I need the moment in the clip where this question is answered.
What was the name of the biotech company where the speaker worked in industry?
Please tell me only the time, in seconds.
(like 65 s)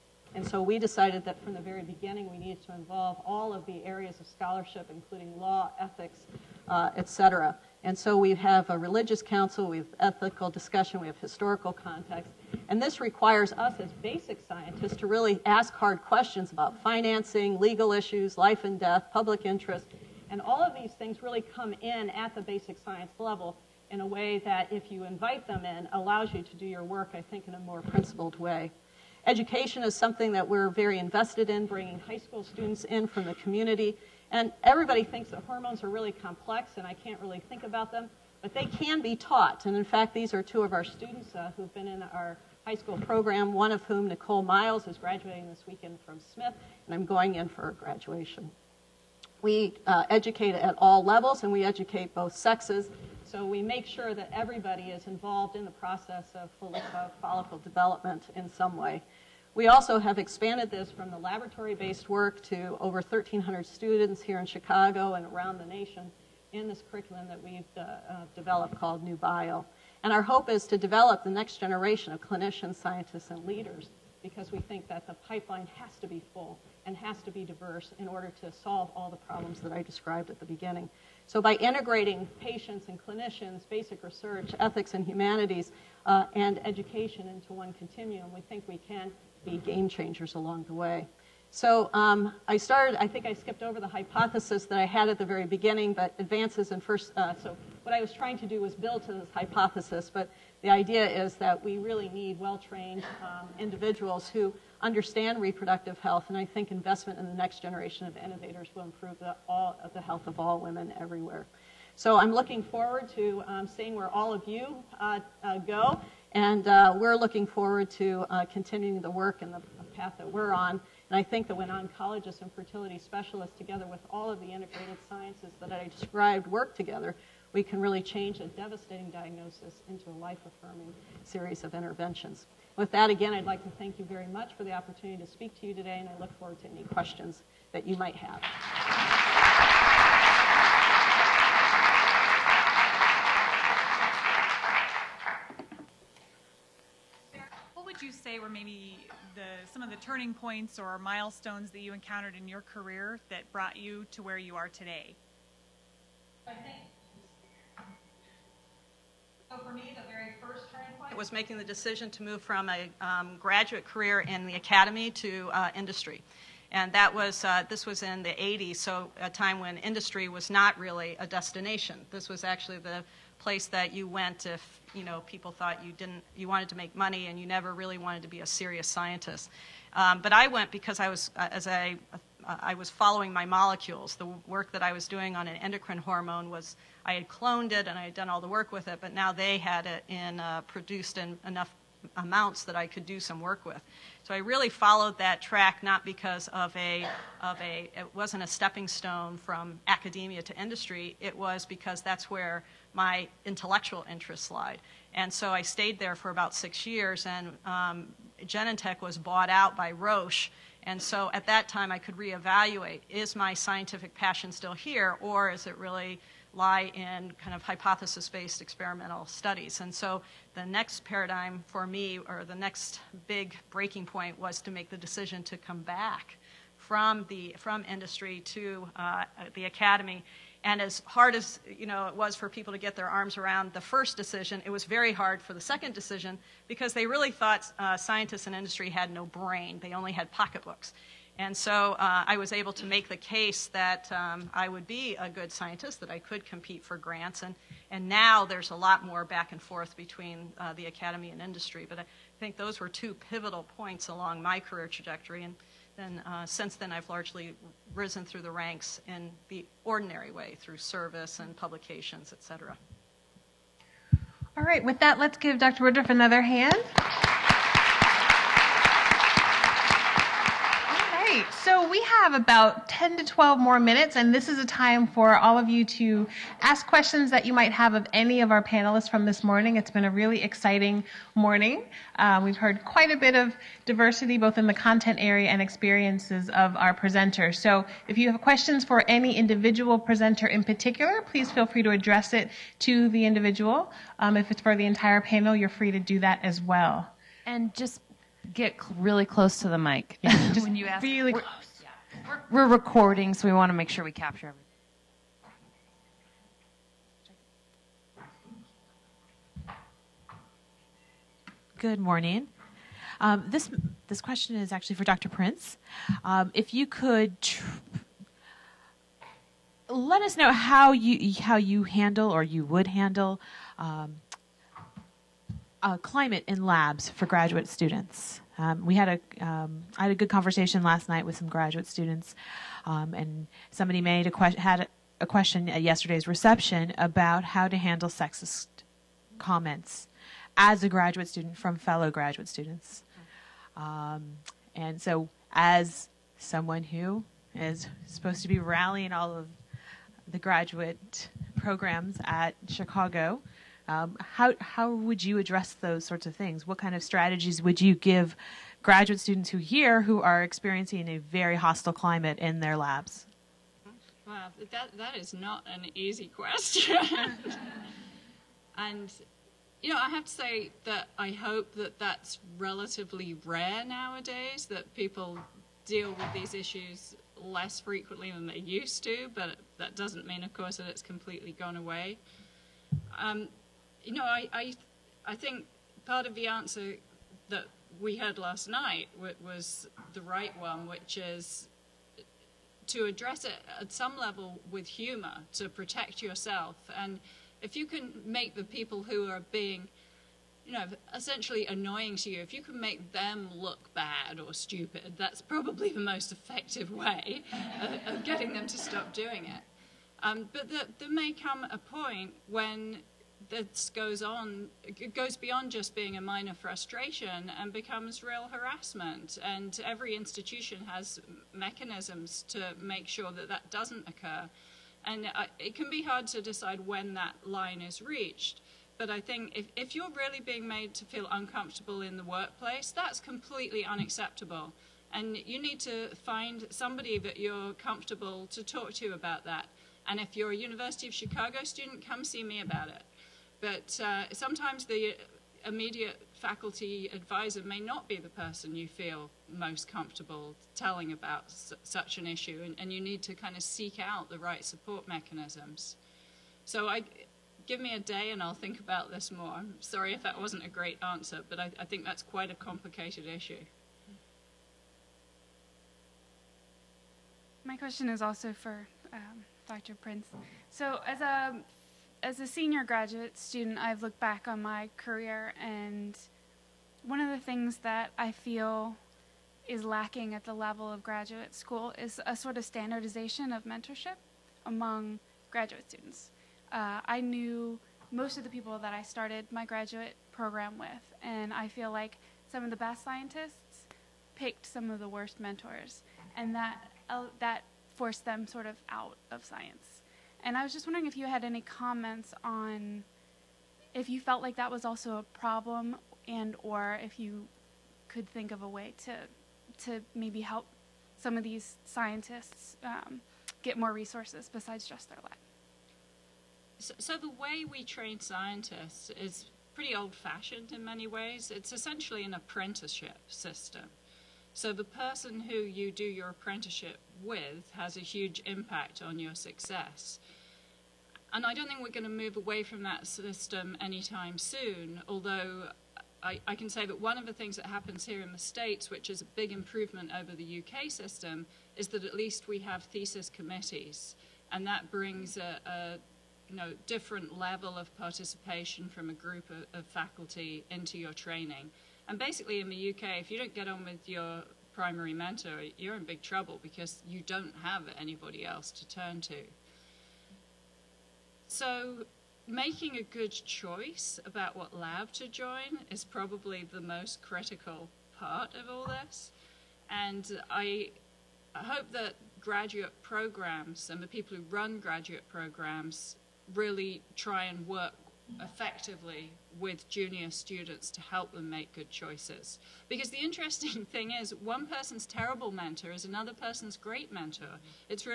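208 s.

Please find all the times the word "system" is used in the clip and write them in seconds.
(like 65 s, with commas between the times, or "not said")
523 s, 533 s, 540 s.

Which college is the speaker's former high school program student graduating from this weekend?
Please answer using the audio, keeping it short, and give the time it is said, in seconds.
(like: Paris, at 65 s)
Smith, at 46 s.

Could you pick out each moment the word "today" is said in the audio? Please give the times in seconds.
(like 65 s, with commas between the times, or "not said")
135 s, 154 s.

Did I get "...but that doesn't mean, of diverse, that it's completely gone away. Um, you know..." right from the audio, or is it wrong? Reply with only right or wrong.
wrong.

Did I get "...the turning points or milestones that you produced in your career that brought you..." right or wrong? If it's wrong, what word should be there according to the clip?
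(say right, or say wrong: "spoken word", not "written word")
wrong: "encountered", not "produced".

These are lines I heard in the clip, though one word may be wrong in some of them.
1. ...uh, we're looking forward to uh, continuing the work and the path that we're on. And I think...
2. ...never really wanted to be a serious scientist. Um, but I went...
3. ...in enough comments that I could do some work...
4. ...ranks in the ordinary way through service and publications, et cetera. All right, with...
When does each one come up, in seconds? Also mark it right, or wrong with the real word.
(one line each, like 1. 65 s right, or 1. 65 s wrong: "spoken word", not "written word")
1. 116 s right
2. 177 s right
3. 191 s wrong: "amounts", not "comments"
4. 258 s right.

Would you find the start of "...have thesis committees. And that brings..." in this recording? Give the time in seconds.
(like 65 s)
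542 s.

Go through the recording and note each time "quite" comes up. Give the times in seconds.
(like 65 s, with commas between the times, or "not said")
282 s, 462 s.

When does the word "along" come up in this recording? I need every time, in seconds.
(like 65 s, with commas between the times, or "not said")
90 s, 254 s.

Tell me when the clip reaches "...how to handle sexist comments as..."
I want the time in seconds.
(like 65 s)
337 s.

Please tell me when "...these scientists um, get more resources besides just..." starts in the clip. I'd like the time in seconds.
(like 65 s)
511 s.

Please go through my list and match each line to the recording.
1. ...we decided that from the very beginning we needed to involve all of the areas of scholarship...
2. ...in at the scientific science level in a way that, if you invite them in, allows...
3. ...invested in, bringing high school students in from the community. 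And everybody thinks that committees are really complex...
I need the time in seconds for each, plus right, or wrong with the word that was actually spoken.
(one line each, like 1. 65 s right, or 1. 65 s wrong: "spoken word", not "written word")
1. 0 s right
2. 21 s wrong: "basic", not "scientific"
3. 30 s wrong: "hormones", not "committees".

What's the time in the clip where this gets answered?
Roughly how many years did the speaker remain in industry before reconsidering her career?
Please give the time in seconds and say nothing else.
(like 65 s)
206 s.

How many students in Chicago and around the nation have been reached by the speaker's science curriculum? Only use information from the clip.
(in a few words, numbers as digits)
1,300.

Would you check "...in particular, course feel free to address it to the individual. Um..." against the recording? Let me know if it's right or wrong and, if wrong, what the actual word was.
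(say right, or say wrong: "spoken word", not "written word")
wrong: "please", not "course".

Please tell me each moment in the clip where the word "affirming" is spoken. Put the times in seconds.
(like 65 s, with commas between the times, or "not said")
130 s.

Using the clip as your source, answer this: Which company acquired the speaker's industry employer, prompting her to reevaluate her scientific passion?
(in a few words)
Roche.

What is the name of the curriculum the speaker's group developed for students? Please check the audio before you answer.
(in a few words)
New Bio.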